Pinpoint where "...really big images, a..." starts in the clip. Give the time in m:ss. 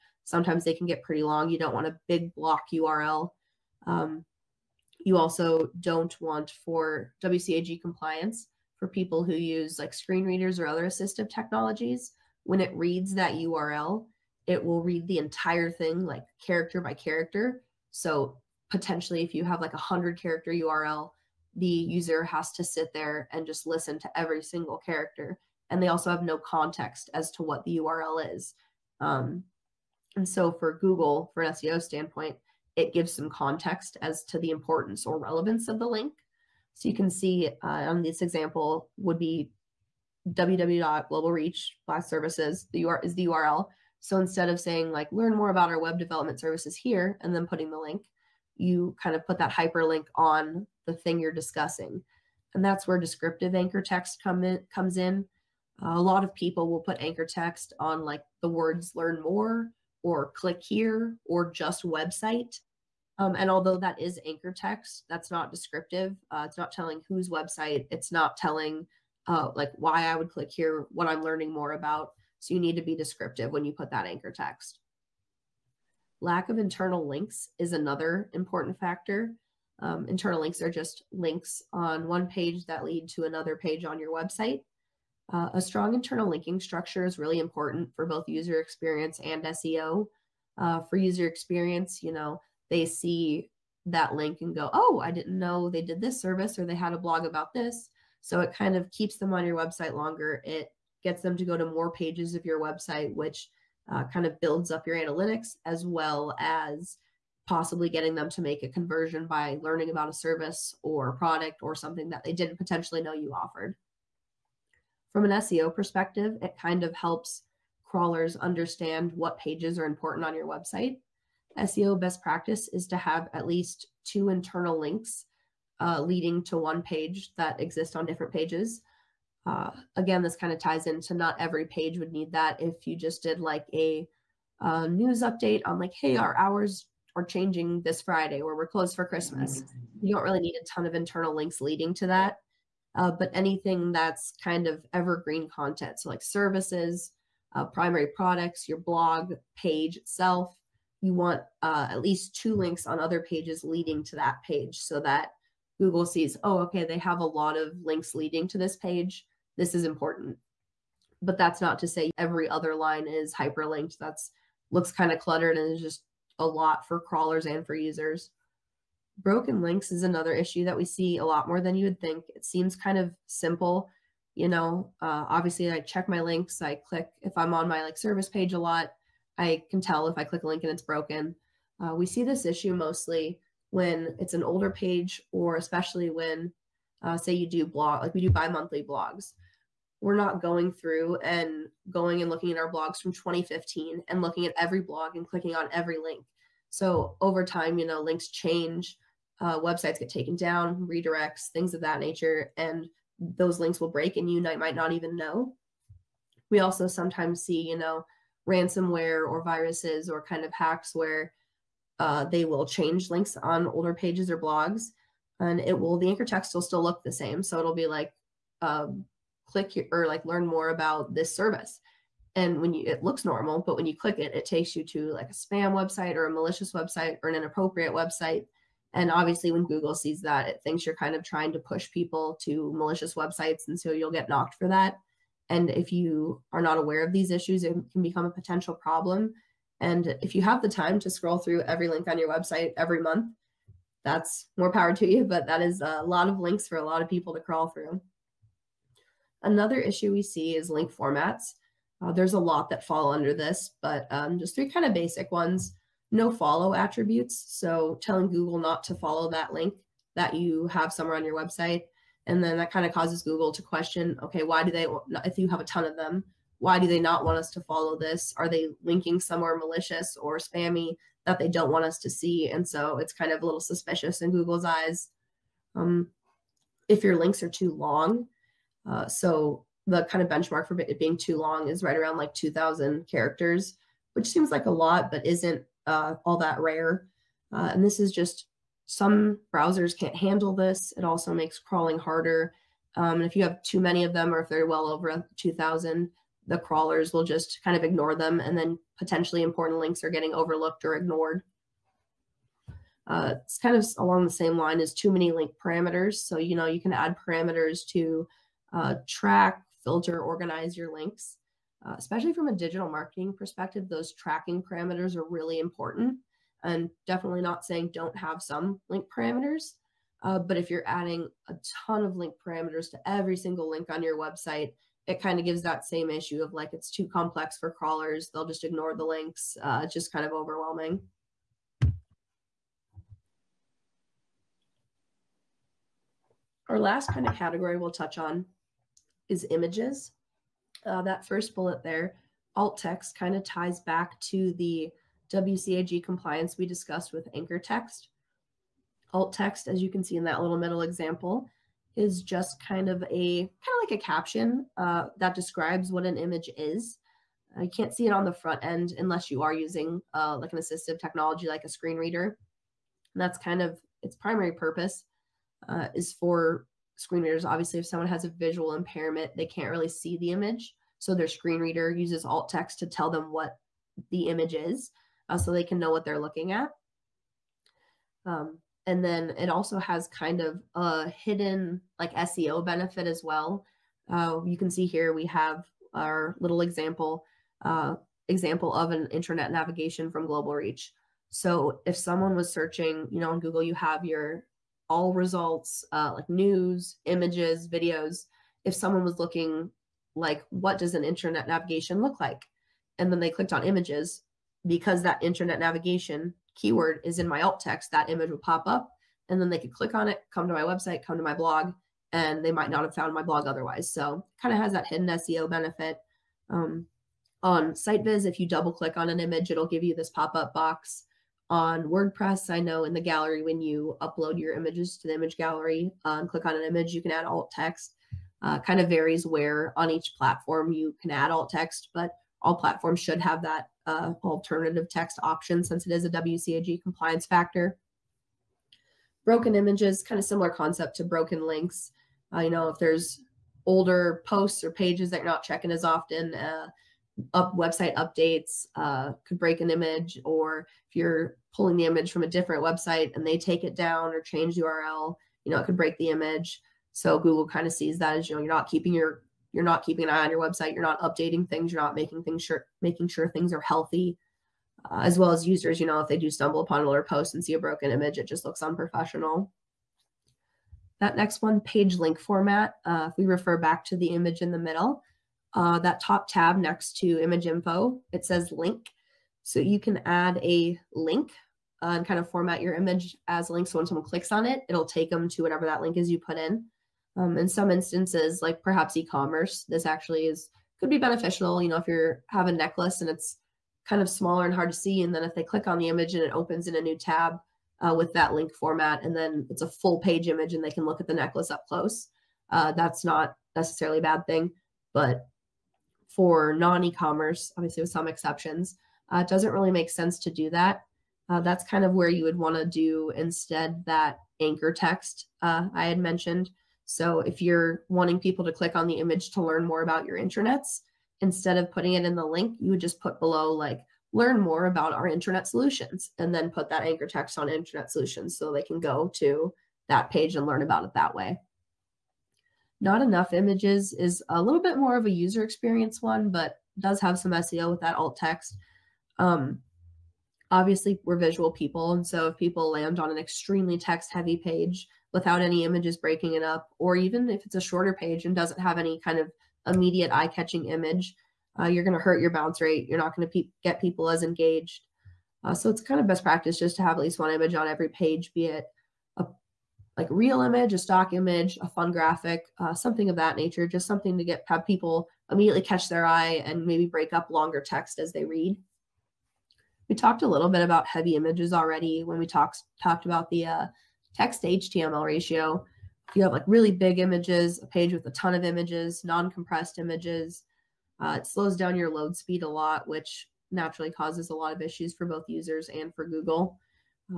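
9:36.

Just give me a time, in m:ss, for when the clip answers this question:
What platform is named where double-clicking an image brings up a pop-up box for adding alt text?
6:57.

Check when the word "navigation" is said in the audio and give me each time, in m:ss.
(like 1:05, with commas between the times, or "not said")
6:29, 6:41, 6:45.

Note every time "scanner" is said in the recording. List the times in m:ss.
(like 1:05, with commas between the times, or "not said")
not said.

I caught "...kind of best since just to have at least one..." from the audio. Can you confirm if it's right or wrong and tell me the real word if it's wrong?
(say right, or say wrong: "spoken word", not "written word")
wrong: "practice", not "since".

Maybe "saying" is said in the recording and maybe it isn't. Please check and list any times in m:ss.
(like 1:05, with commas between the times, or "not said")
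0:44, 5:17.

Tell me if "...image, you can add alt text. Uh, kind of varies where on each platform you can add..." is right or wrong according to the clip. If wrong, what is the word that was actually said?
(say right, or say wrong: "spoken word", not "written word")
right.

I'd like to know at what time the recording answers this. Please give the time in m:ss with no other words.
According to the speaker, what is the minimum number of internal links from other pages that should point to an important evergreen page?
2:03.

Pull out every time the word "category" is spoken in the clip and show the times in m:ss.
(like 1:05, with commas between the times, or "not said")
5:37.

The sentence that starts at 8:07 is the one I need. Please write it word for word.
Um, in some instances, like perhaps e-commerce, this actually is could be beneficial.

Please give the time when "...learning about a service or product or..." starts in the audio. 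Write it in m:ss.
1:49.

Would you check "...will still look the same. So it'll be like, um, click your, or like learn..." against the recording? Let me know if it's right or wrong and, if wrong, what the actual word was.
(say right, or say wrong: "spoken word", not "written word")
right.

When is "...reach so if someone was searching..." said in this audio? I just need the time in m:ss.
6:30.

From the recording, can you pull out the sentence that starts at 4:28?
Are they linking somewhere malicious or spammy that they don't want us to see?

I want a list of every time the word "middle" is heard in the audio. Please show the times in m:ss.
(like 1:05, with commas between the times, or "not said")
5:50, 7:54.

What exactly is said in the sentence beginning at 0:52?
And that's where descriptive anchor text come in, comes in.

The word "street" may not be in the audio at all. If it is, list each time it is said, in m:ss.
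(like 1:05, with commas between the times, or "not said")
not said.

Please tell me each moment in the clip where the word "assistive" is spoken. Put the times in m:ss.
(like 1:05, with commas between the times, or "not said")
0:10, 6:00.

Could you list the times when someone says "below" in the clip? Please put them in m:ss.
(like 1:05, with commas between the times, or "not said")
8:43.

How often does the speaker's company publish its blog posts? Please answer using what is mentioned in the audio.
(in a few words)
Bi-monthly.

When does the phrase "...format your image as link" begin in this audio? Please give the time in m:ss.
8:02.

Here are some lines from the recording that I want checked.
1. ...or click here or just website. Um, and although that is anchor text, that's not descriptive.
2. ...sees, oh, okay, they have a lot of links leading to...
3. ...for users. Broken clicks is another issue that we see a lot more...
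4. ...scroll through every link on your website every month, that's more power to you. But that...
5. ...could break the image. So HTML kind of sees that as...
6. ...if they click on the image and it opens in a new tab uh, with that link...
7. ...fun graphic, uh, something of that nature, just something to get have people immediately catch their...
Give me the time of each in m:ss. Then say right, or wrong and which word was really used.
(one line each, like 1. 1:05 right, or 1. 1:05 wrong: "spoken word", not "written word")
1. 1:00 right
2. 2:36 right
3. 2:47 wrong: "links", not "clicks"
4. 4:01 right
5. 7:35 wrong: "Google", not "HTML"
6. 8:15 right
7. 9:21 right.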